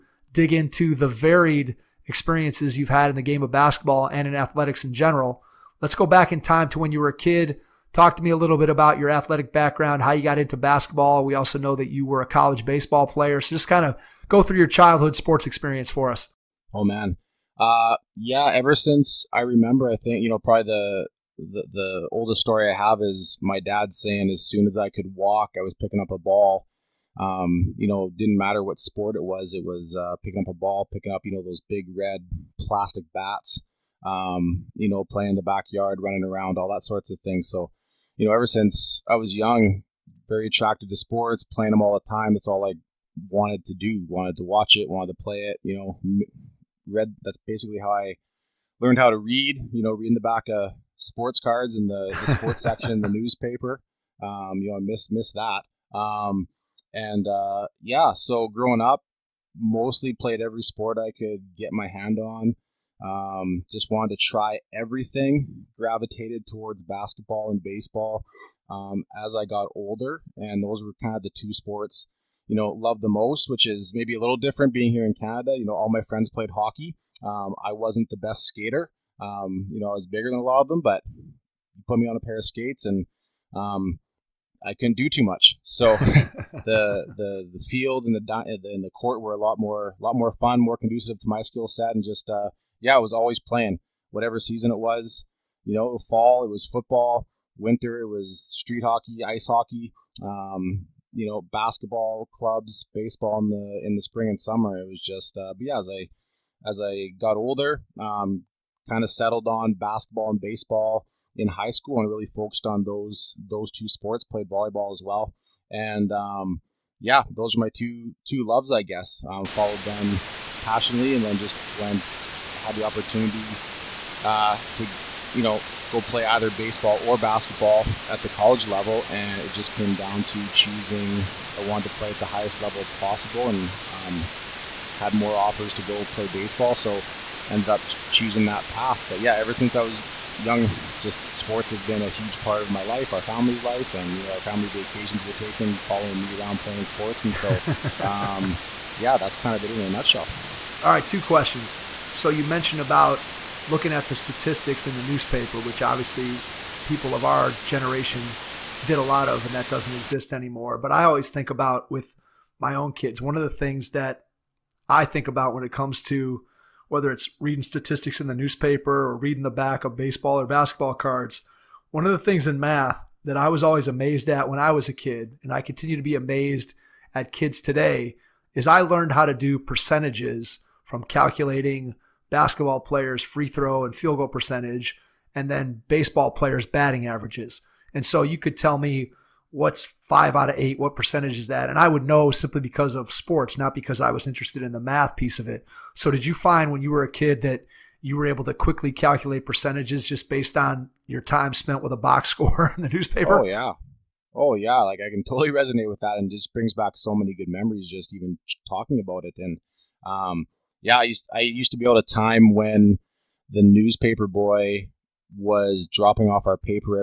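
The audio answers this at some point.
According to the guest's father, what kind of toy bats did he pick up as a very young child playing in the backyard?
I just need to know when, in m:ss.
0:31.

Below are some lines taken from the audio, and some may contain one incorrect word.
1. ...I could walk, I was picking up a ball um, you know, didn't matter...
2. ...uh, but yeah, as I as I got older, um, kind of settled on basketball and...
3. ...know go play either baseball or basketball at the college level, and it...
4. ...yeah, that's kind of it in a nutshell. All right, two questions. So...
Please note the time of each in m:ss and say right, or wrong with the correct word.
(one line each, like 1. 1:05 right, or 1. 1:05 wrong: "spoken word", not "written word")
1. 0:24 right
2. 1:45 right
3. 2:05 right
4. 2:28 right.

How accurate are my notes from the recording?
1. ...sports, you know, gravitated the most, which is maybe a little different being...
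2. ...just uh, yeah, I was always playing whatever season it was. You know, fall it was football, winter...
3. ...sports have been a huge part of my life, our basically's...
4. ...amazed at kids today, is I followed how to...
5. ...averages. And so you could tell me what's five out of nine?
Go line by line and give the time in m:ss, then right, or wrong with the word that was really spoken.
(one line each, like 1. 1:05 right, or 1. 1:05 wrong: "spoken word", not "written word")
1. 1:11 wrong: "loved", not "gravitated"
2. 1:32 right
3. 2:21 wrong: "family", not "basically"
4. 2:56 wrong: "learned", not "followed"
5. 3:07 wrong: "eight", not "nine".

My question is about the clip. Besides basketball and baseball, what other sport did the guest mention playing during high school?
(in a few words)
volleyball.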